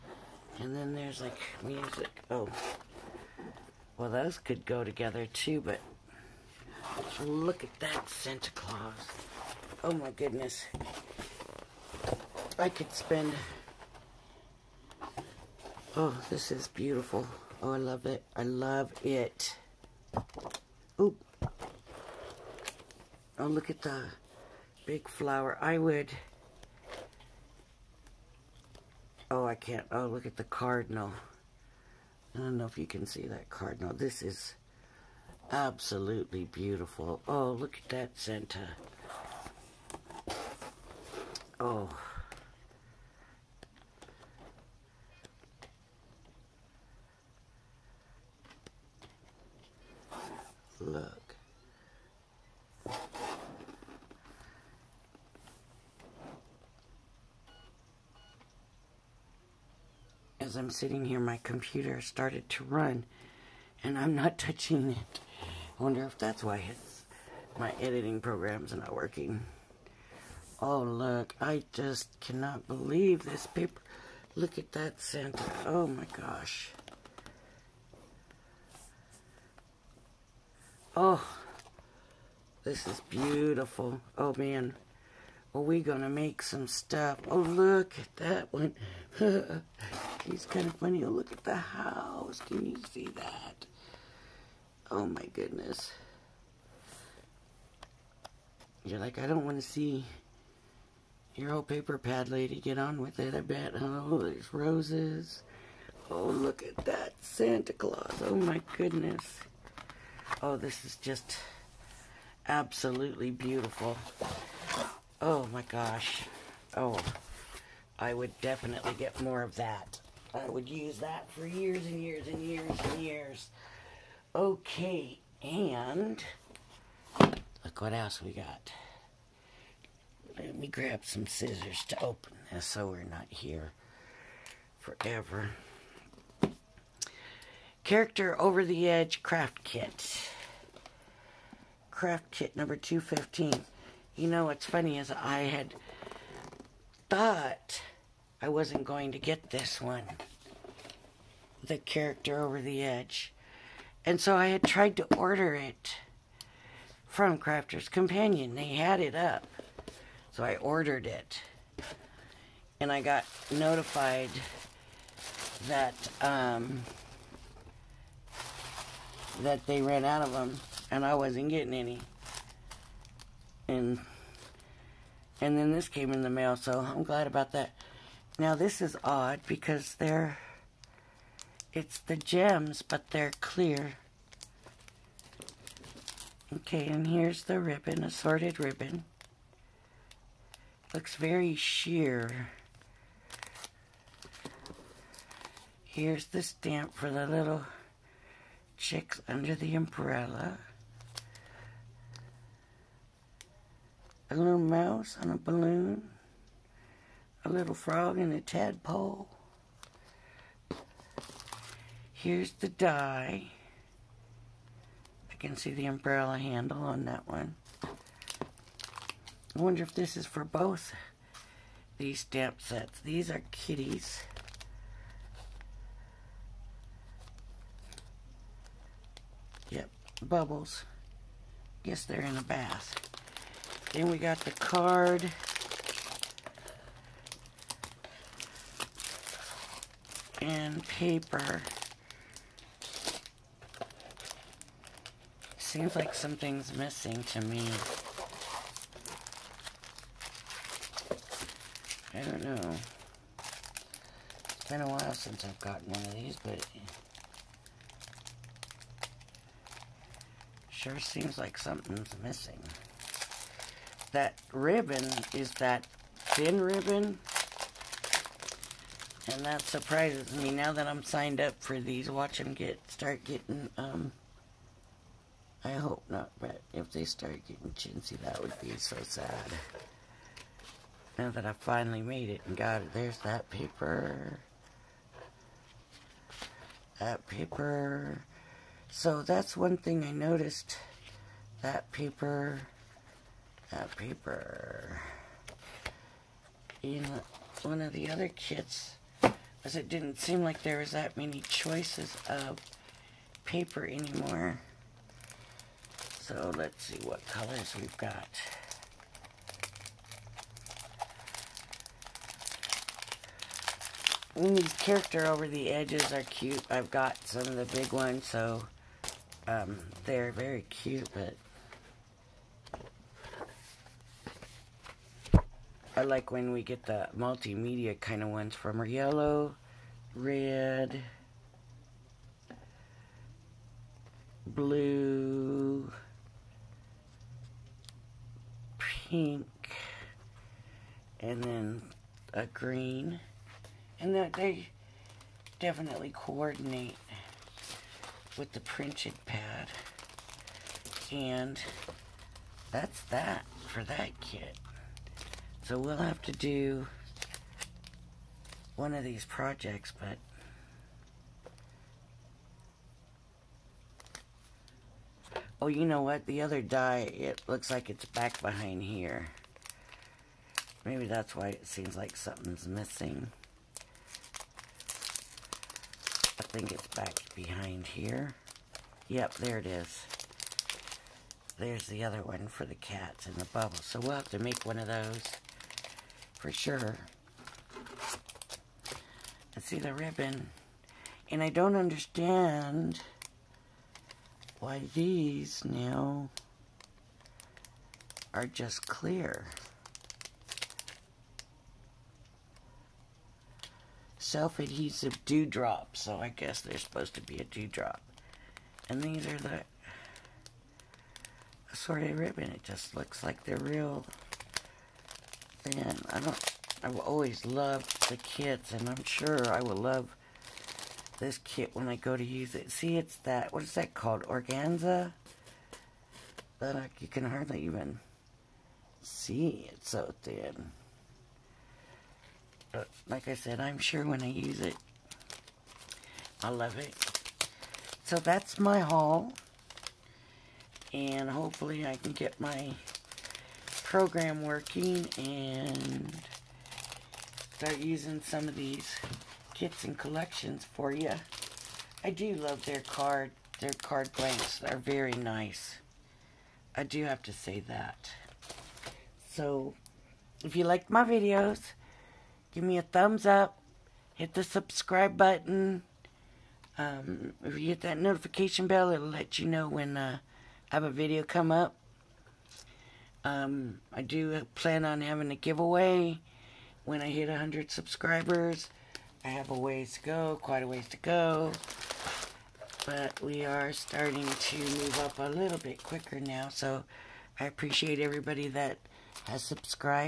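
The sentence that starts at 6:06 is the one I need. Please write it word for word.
The other die, it looks like it's back behind here.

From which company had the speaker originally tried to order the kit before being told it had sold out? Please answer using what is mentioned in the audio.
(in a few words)
Crafter's Companion.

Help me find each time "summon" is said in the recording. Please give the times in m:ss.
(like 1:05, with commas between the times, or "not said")
not said.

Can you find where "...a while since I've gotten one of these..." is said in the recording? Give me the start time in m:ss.
4:14.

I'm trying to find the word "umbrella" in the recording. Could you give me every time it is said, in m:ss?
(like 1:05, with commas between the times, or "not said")
3:19, 3:35.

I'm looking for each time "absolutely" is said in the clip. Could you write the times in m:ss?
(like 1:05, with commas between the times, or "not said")
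0:35, 1:52.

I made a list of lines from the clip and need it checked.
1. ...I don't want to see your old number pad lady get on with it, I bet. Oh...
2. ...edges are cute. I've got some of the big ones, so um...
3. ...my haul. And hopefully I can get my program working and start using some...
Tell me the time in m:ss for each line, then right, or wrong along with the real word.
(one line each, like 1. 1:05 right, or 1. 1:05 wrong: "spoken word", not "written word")
1. 1:39 wrong: "paper", not "number"
2. 5:15 right
3. 7:18 right.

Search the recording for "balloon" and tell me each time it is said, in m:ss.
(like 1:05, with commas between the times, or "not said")
3:25.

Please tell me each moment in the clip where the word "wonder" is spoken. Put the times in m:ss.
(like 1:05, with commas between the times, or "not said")
1:05, 3:39.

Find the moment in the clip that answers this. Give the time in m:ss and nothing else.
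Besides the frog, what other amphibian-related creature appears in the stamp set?
3:28.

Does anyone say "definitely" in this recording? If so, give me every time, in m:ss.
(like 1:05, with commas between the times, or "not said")
1:58, 5:45.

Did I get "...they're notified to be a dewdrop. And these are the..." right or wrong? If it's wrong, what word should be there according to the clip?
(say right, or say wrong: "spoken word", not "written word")
wrong: "supposed", not "notified".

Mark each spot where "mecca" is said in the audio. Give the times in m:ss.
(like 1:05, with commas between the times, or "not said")
not said.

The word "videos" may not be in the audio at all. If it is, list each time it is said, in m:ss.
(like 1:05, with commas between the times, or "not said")
7:41, 7:50.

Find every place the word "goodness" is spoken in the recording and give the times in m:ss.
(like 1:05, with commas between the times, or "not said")
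0:10, 1:35, 1:48.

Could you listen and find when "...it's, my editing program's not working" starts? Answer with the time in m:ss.
1:06.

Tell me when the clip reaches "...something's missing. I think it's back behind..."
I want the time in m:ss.
6:12.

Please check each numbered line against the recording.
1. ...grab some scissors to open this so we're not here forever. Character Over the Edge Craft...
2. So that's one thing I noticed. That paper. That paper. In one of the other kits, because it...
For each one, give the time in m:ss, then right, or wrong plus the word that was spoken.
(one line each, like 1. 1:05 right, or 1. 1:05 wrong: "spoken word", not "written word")
1. 2:10 right
2. 4:48 right.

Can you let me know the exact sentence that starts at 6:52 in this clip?
It just looks like they're real I don't.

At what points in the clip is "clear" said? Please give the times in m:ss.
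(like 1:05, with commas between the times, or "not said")
3:03, 6:38.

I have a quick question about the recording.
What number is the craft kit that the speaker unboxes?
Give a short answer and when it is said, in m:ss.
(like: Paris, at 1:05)
215, at 2:22.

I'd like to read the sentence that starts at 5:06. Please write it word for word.
So let's see what colors we've got.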